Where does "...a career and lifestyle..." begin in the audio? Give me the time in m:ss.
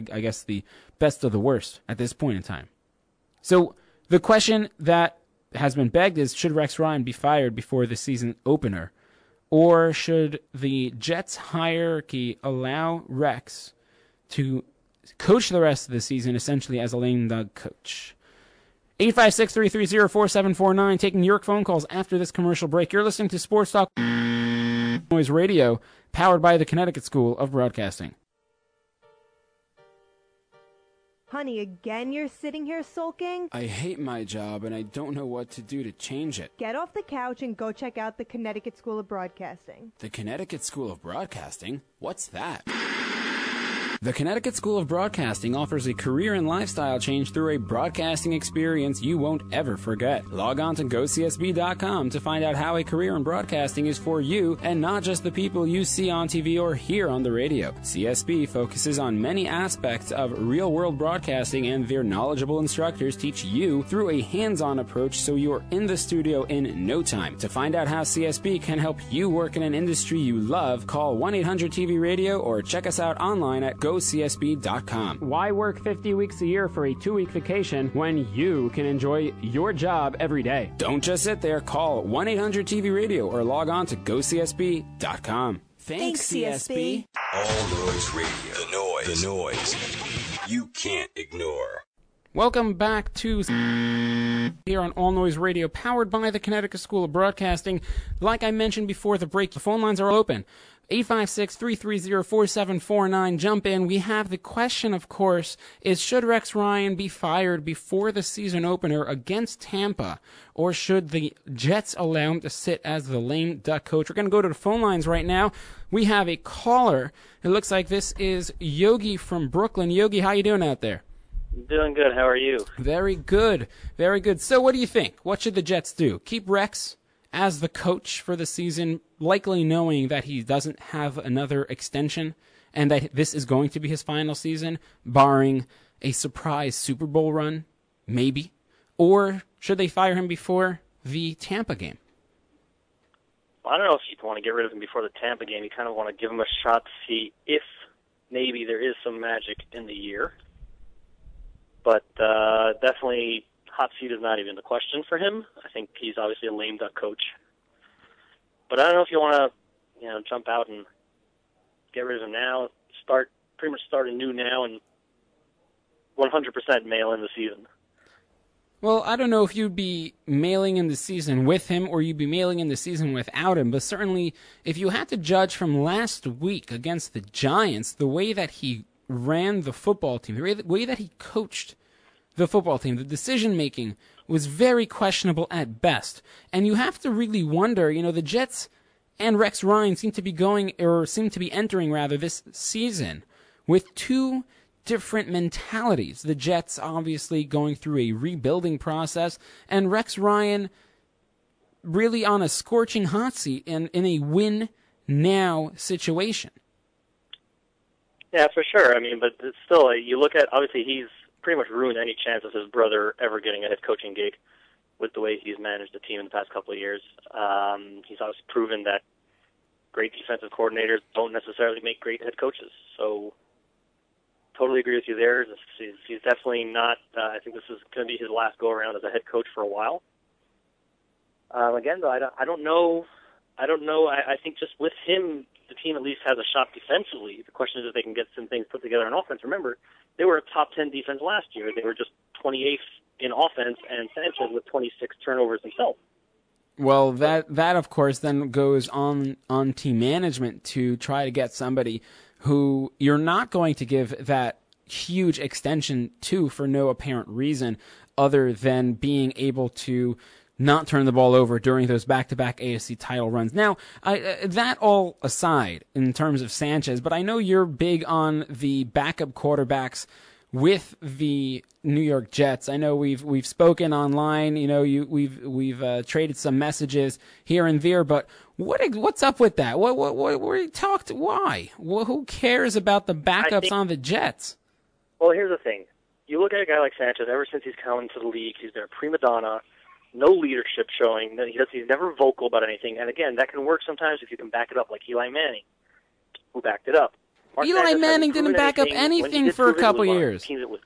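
0:45.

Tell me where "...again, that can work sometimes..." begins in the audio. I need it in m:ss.
4:53.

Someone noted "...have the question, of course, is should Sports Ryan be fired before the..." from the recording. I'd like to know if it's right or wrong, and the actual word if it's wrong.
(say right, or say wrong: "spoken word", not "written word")
wrong: "Rex", not "Sports".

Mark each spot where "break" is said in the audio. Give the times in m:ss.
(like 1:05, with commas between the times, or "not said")
0:22, 1:39.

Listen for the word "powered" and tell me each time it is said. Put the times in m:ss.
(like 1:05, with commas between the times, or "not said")
0:26, 1:35.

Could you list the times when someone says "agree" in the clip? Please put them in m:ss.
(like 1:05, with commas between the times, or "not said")
3:44.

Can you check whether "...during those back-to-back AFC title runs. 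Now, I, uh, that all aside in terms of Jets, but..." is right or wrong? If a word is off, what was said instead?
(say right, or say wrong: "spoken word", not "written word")
wrong: "Sanchez", not "Jets".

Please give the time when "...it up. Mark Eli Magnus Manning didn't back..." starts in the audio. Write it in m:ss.
4:56.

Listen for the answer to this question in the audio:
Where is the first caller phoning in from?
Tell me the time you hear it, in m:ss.
1:59.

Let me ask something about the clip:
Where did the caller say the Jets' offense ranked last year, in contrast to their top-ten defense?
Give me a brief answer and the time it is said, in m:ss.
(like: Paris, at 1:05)
28th, at 4:02.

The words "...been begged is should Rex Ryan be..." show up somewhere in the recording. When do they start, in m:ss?
0:05.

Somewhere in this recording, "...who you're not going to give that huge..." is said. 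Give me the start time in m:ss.
4:12.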